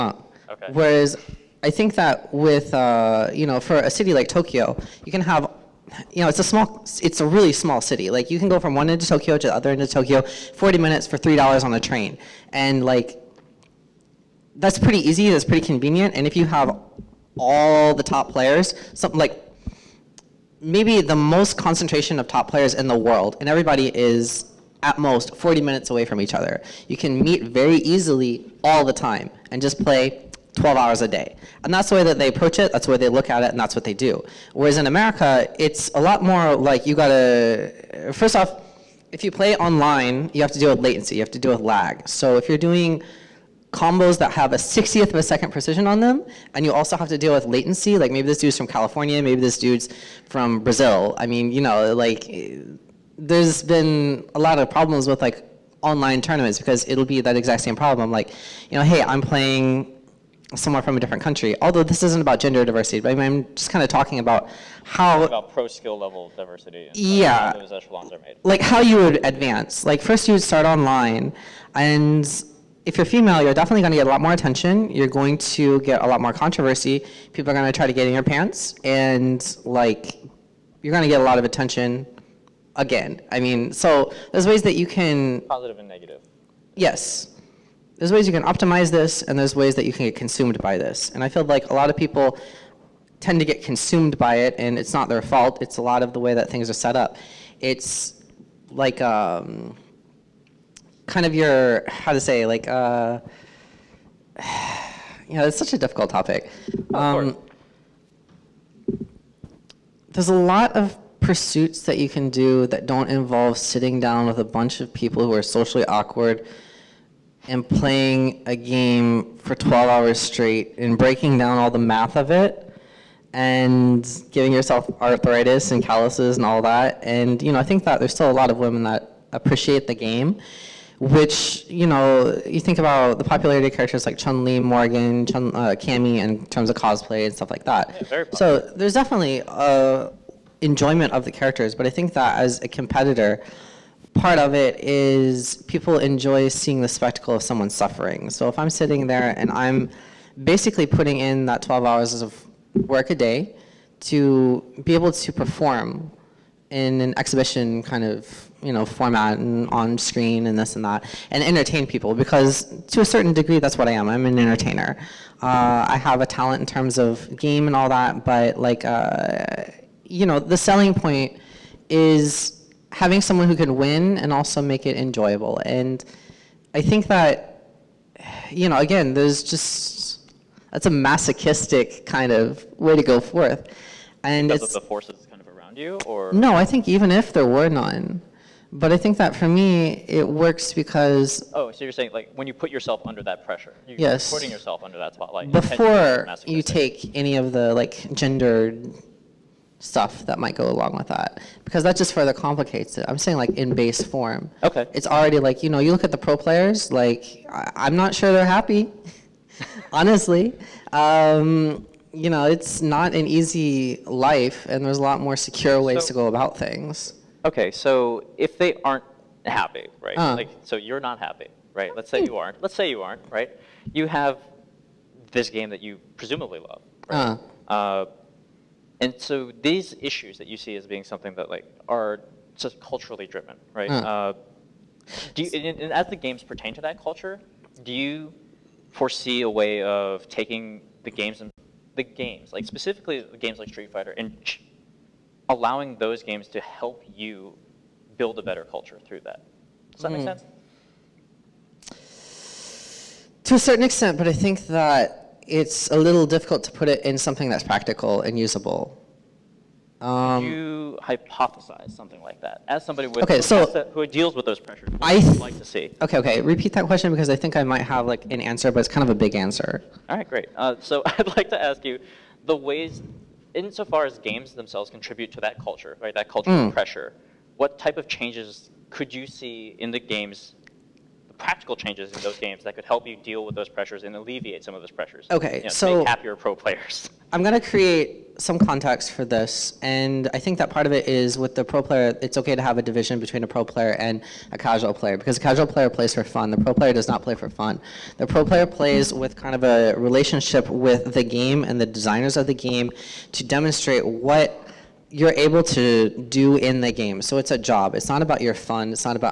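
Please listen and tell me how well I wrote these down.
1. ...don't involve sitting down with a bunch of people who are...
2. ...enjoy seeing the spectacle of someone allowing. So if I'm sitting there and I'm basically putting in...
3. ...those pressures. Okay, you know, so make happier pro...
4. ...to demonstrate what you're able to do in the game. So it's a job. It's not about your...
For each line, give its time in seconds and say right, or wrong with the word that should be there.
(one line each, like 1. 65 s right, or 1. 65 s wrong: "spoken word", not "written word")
1. 112 s right
2. 145 s wrong: "suffering", not "allowing"
3. 284 s right
4. 303 s right.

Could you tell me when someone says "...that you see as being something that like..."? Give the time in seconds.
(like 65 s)
230 s.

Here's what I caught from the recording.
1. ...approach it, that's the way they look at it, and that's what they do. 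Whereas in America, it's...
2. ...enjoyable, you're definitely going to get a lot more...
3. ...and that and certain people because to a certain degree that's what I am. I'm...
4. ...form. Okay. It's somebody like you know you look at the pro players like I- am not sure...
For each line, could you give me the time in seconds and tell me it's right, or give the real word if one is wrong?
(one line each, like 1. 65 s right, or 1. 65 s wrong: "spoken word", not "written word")
1. 32 s right
2. 73 s wrong: "female", not "enjoyable"
3. 160 s wrong: "entertain", not "certain"
4. 204 s wrong: "already", not "somebody".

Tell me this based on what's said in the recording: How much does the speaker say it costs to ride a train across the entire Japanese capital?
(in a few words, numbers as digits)
$3.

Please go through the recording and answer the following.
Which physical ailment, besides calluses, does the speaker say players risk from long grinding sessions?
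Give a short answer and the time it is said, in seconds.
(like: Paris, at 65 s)
Arthritis, at 125 s.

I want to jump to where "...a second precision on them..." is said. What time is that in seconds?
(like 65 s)
45 s.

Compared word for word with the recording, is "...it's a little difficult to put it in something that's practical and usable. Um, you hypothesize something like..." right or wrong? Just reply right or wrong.
right.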